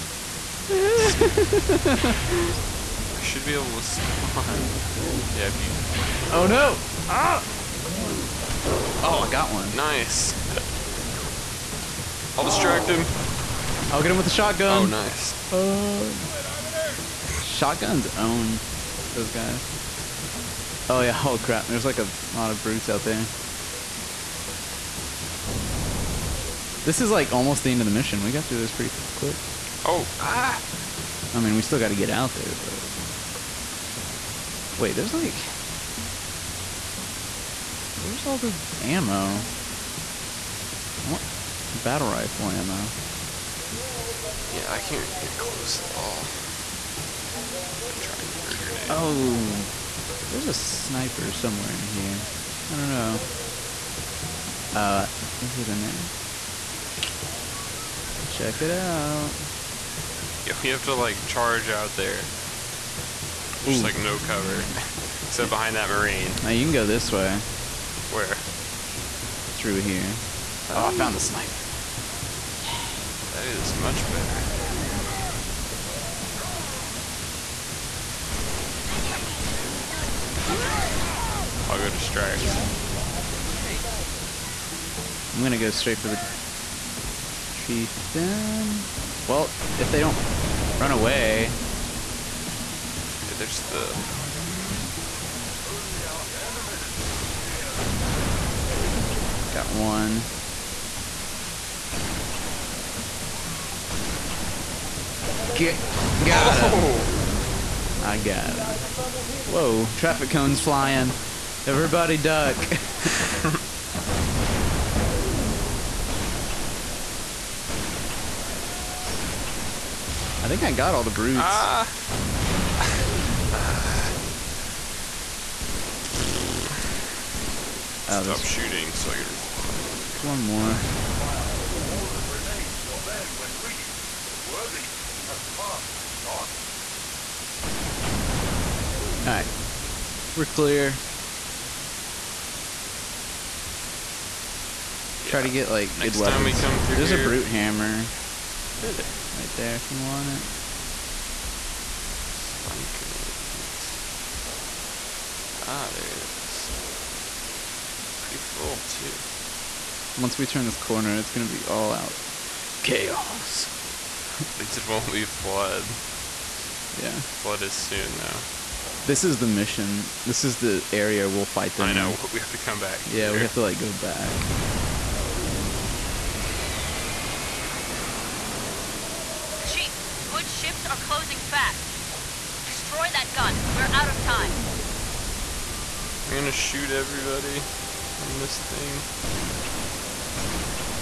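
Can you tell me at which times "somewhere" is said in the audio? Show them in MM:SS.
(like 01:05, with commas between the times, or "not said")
00:51.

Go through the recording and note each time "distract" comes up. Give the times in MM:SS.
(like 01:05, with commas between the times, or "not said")
00:12, 01:21.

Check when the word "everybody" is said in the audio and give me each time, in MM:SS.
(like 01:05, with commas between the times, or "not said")
01:51, 03:06.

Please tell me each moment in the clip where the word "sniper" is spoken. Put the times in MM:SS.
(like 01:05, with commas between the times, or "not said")
00:50, 01:11.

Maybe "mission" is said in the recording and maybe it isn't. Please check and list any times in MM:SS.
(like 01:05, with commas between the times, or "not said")
00:27, 02:49.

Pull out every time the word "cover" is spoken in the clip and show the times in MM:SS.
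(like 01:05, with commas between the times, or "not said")
01:04.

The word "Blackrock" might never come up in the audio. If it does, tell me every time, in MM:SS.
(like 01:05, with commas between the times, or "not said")
not said.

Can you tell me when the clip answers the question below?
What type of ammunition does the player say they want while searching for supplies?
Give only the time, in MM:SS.
00:41.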